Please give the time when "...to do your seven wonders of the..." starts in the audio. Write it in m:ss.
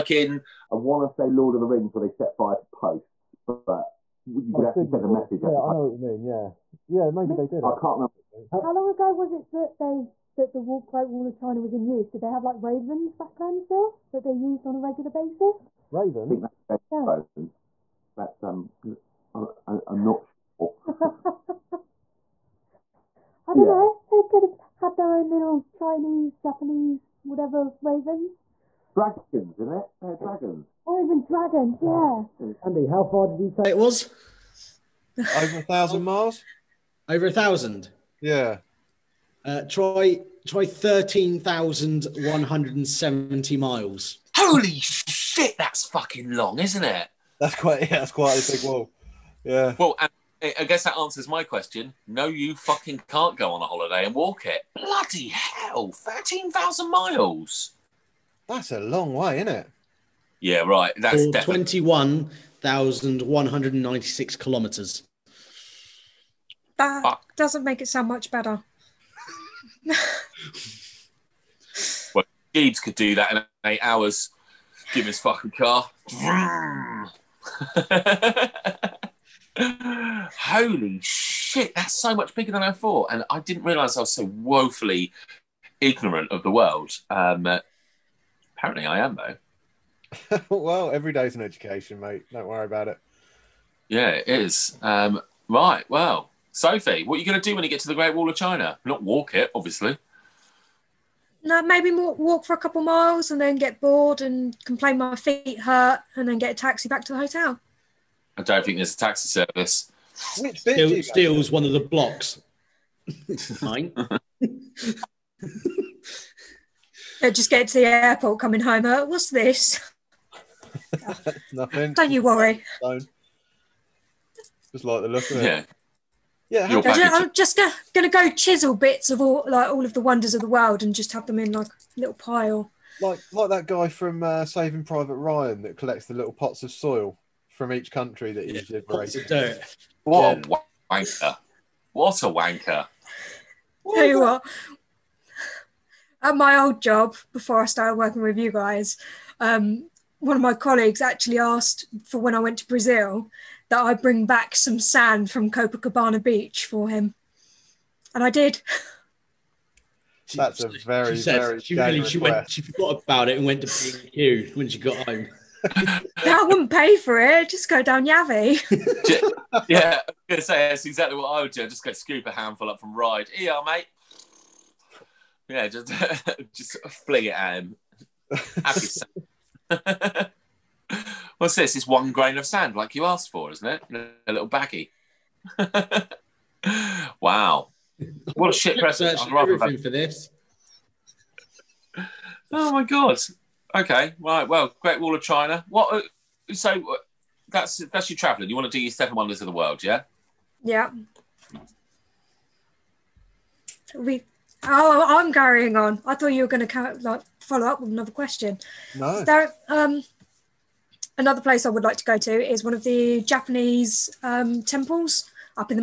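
3:18.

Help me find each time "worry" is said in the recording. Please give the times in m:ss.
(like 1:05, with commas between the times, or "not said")
1:32, 2:02.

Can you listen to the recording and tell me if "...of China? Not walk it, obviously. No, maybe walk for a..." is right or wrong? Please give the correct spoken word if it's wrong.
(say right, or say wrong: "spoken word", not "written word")
right.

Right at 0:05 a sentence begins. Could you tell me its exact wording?
Yeah, I know what you mean.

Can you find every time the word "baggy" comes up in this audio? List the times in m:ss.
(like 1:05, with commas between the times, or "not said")
3:04.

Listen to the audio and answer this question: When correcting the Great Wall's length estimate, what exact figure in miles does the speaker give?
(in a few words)
13,170 miles.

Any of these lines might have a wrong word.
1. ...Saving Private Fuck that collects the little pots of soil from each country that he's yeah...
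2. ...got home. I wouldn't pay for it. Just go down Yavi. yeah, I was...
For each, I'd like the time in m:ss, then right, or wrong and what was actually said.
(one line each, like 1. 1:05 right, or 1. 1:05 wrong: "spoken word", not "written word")
1. 2:14 wrong: "Ryan", not "Fuck"
2. 2:44 right.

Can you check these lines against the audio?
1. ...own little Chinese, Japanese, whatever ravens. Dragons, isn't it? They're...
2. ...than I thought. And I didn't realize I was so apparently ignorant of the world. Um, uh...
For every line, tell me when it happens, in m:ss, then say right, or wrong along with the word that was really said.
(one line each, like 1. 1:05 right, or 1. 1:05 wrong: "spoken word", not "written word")
1. 0:25 right
2. 1:22 wrong: "woefully", not "apparently".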